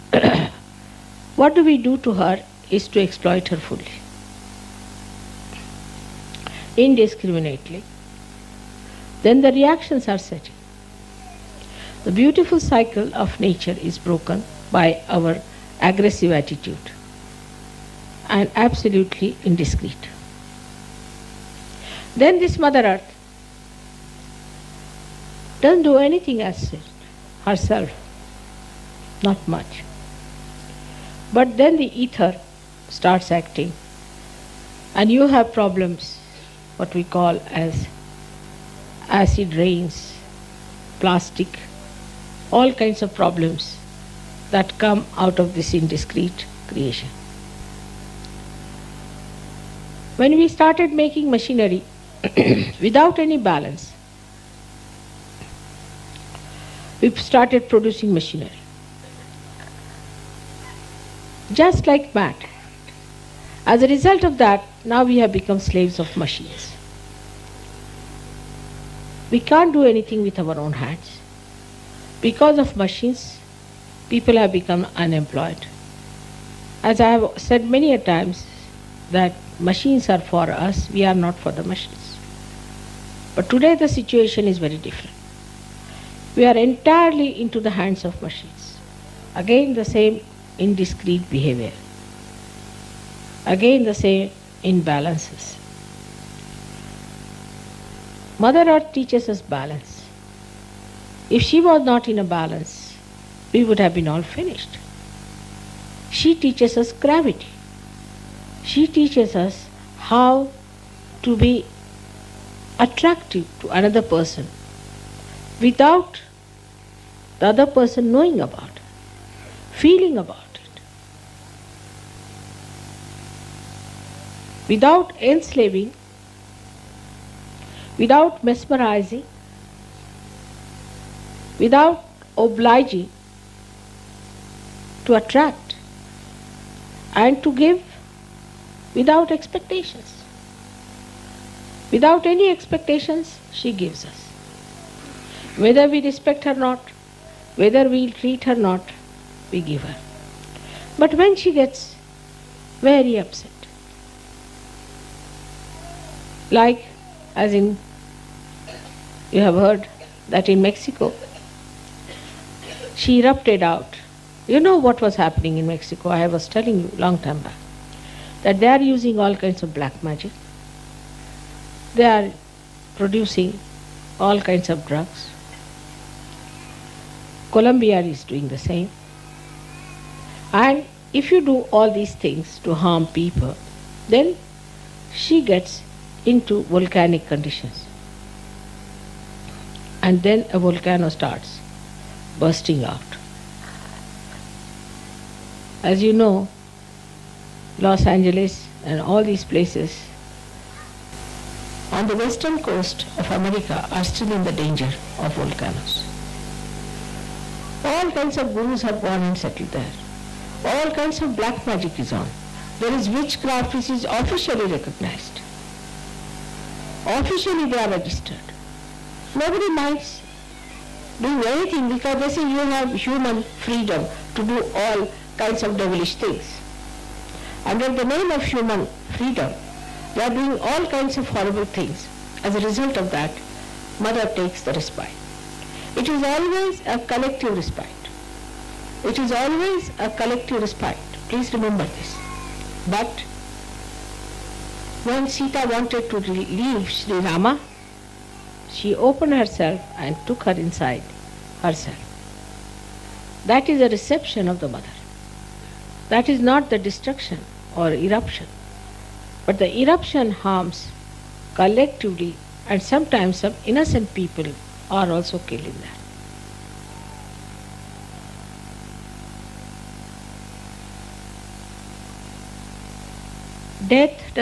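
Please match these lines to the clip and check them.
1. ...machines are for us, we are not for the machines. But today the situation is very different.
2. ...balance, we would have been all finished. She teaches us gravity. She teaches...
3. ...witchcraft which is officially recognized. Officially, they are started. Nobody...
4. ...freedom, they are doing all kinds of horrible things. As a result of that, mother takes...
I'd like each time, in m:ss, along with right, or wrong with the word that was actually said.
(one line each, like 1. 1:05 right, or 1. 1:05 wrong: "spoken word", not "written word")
1. 1:19 right
2. 1:42 right
3. 3:33 wrong: "registered", not "started"
4. 3:49 right.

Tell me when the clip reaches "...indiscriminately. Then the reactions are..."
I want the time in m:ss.
0:06.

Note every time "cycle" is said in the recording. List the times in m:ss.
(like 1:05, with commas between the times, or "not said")
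0:12.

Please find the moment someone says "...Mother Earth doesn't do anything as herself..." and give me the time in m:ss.
0:22.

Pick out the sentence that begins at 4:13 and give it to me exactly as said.
That is a reception of the mother.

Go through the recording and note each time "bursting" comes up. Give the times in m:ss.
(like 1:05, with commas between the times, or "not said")
3:12.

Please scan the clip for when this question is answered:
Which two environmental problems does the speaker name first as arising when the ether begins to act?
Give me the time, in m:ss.
0:39.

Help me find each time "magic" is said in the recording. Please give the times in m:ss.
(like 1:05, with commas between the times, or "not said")
2:50, 3:31.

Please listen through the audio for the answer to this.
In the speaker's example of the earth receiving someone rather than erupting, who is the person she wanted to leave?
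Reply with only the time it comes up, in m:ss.
4:06.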